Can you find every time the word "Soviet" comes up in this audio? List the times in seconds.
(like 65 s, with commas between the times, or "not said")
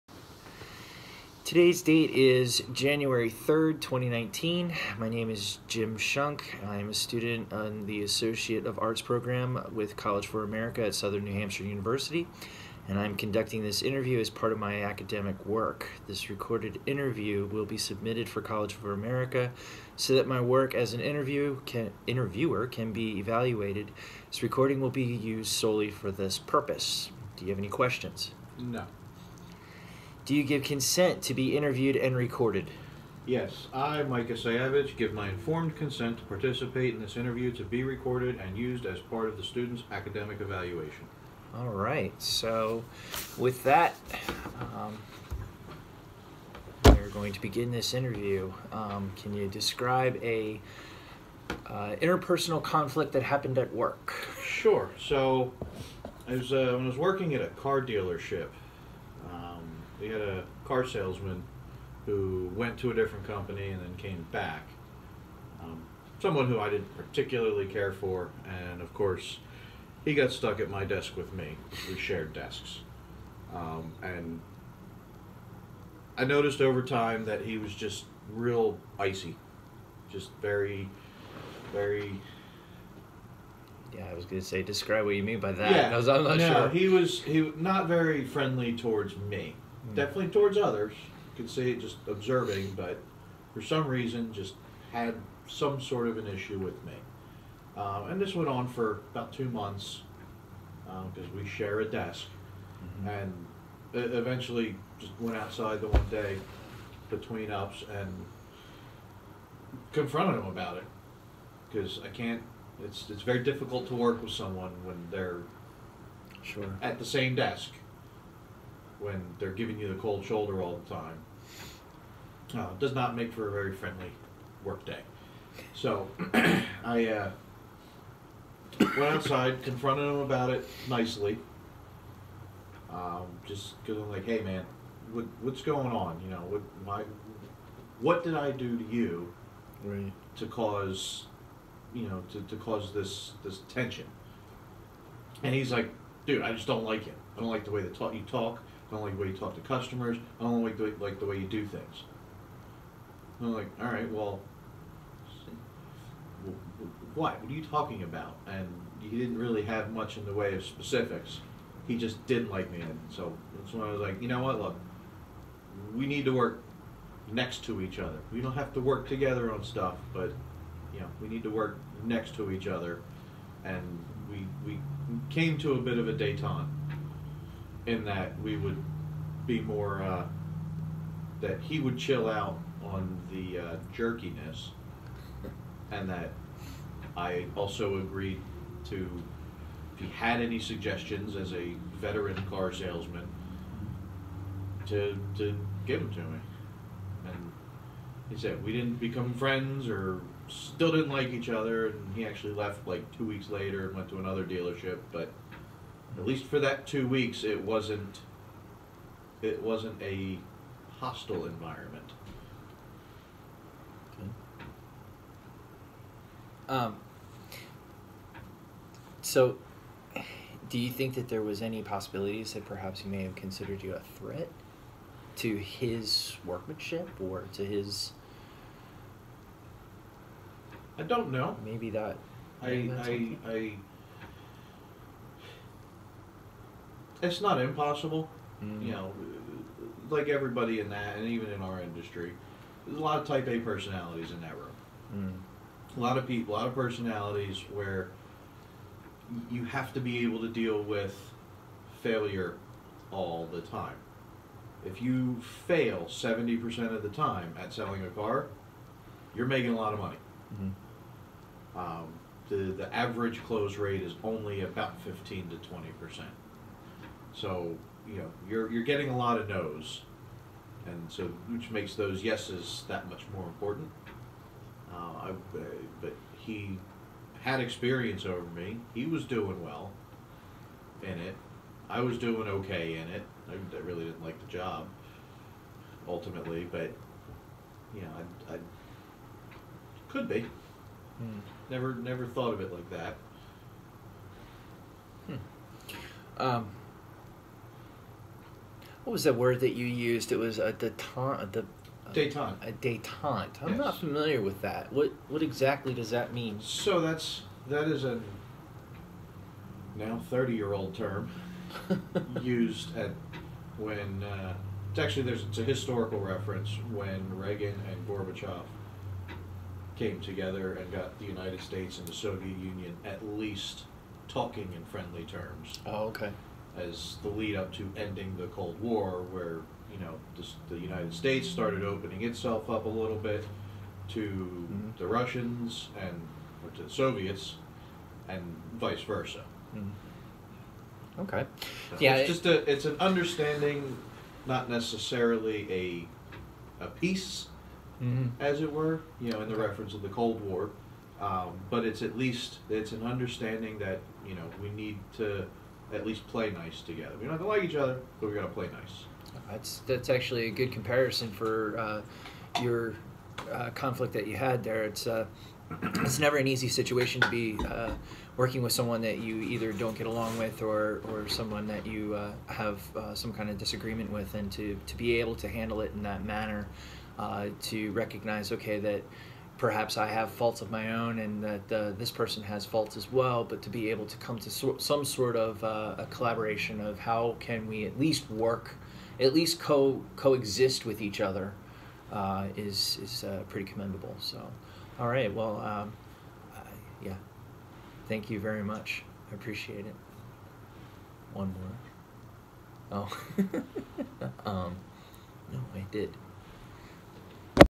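322 s, 336 s.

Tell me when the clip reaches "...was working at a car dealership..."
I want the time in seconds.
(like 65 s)
56 s.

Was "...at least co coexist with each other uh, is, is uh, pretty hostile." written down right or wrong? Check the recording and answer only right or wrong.
wrong.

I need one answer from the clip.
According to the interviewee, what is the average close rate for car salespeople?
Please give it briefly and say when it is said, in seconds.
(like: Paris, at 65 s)
15 to 20%, at 265 s.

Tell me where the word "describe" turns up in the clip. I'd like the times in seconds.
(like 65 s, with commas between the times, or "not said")
49 s, 84 s.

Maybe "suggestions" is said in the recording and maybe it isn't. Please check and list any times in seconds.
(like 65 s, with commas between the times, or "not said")
190 s.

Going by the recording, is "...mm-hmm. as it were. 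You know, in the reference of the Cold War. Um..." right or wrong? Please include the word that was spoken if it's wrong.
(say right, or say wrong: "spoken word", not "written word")
right.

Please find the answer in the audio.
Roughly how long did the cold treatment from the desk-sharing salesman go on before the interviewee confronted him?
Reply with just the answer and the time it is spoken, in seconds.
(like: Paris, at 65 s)
about two months, at 99 s.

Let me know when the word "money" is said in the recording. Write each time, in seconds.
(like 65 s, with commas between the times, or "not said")
259 s.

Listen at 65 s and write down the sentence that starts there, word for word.
Um, someone who I didn't particularly care for, and of course, he got stuck at my desk with me.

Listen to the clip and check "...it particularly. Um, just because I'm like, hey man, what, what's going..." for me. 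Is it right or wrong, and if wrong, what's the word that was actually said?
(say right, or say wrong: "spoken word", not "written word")
wrong: "nicely", not "particularly".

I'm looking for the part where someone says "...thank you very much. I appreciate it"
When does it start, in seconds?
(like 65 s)
398 s.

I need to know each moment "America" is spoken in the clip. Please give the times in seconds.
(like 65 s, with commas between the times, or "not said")
10 s, 18 s.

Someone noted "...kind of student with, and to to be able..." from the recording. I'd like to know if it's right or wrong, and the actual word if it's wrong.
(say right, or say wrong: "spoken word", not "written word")
wrong: "disagreement", not "student".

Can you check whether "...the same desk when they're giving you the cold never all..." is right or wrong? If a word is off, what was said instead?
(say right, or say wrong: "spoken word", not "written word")
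wrong: "shoulder", not "never".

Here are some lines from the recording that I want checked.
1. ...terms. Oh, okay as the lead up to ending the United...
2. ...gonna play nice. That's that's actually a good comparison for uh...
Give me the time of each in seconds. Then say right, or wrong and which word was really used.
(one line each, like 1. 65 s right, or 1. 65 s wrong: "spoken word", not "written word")
1. 325 s wrong: "Cold", not "United"
2. 358 s right.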